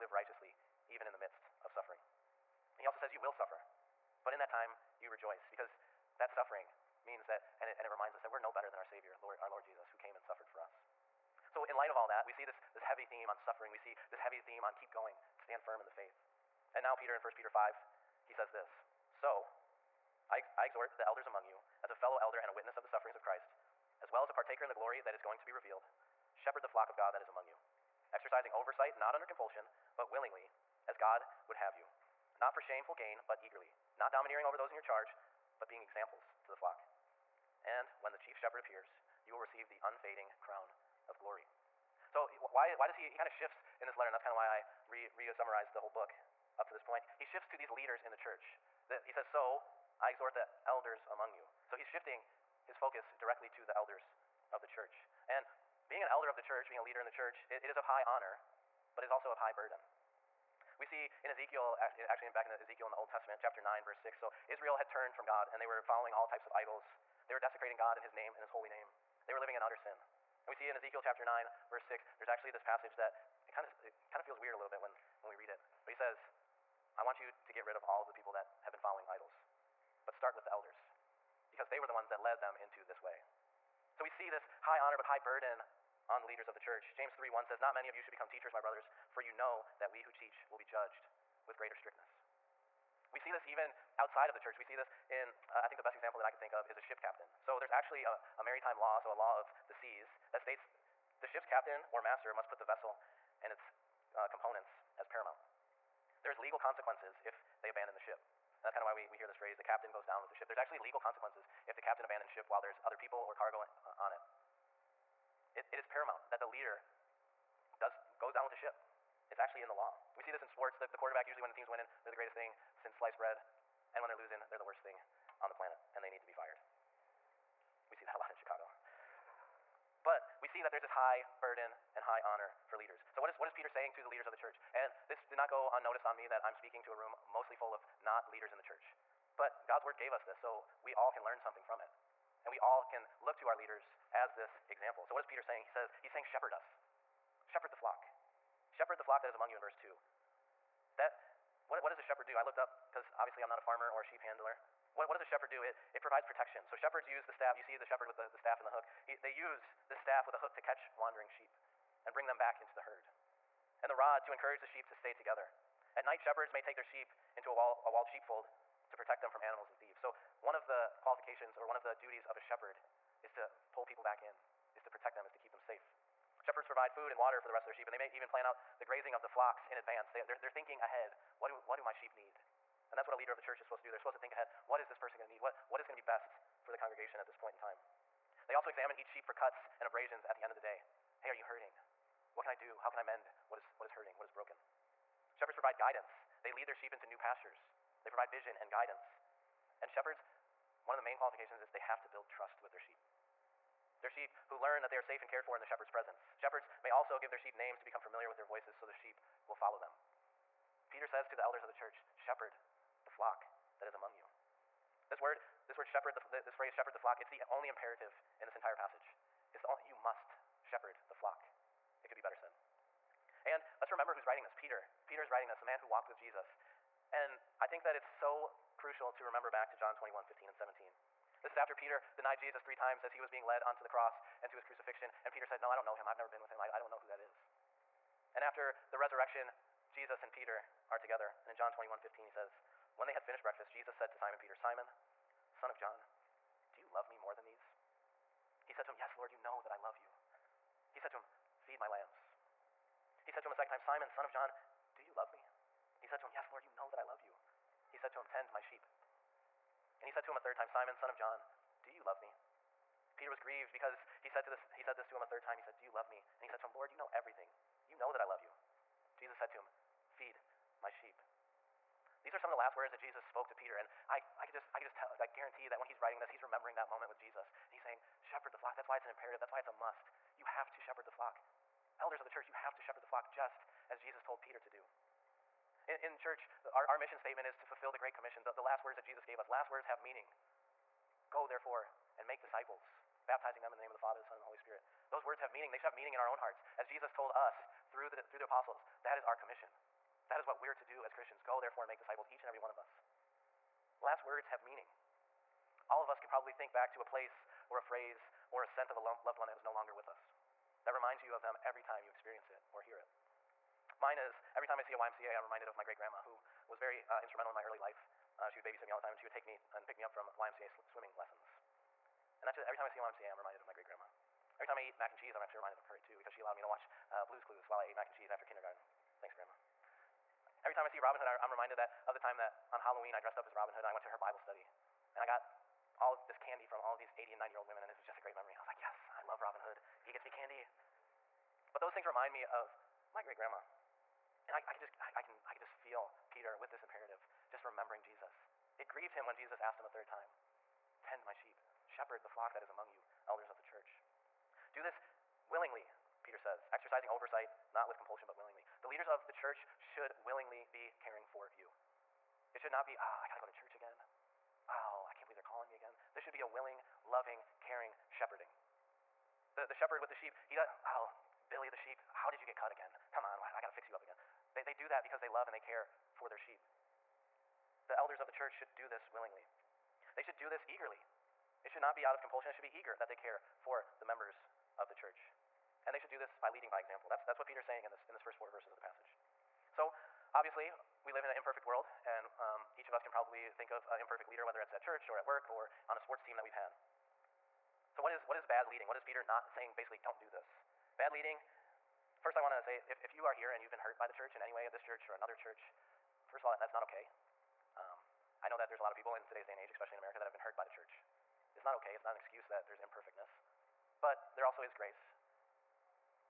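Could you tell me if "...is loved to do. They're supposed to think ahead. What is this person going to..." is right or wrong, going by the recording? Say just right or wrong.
wrong.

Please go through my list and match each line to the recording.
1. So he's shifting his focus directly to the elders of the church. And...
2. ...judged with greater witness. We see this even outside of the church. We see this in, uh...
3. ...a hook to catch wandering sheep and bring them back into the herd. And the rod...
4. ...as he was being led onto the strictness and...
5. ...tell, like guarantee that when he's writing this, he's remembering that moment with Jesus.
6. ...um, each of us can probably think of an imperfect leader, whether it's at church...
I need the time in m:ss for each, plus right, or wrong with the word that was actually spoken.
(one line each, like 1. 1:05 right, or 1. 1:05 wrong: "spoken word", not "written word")
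1. 0:51 right
2. 1:30 wrong: "strictness", not "witness"
3. 2:40 right
4. 3:53 wrong: "cross", not "strictness"
5. 4:34 right
6. 6:32 right.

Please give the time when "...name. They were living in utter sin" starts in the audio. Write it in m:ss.
1:08.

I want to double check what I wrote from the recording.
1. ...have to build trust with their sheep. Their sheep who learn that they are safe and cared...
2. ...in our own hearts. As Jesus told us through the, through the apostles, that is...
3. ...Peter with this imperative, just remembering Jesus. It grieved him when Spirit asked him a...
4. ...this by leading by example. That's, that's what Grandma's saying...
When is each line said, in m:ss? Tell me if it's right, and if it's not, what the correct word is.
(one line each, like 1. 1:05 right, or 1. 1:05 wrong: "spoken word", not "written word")
1. 3:21 right
2. 4:56 right
3. 5:46 wrong: "Jesus", not "Spirit"
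4. 6:26 wrong: "Peter", not "Grandma".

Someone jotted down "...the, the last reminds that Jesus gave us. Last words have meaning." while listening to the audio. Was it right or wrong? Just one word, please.
wrong.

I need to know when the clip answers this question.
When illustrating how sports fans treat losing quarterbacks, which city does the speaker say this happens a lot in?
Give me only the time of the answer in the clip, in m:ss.
2:08.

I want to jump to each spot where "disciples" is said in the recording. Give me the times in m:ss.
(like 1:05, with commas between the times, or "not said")
4:52, 5:01.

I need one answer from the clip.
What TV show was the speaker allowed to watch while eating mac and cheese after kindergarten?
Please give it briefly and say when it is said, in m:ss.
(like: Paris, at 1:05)
Blues Clues, at 5:27.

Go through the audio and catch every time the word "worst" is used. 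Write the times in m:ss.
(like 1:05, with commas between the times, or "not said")
2:04.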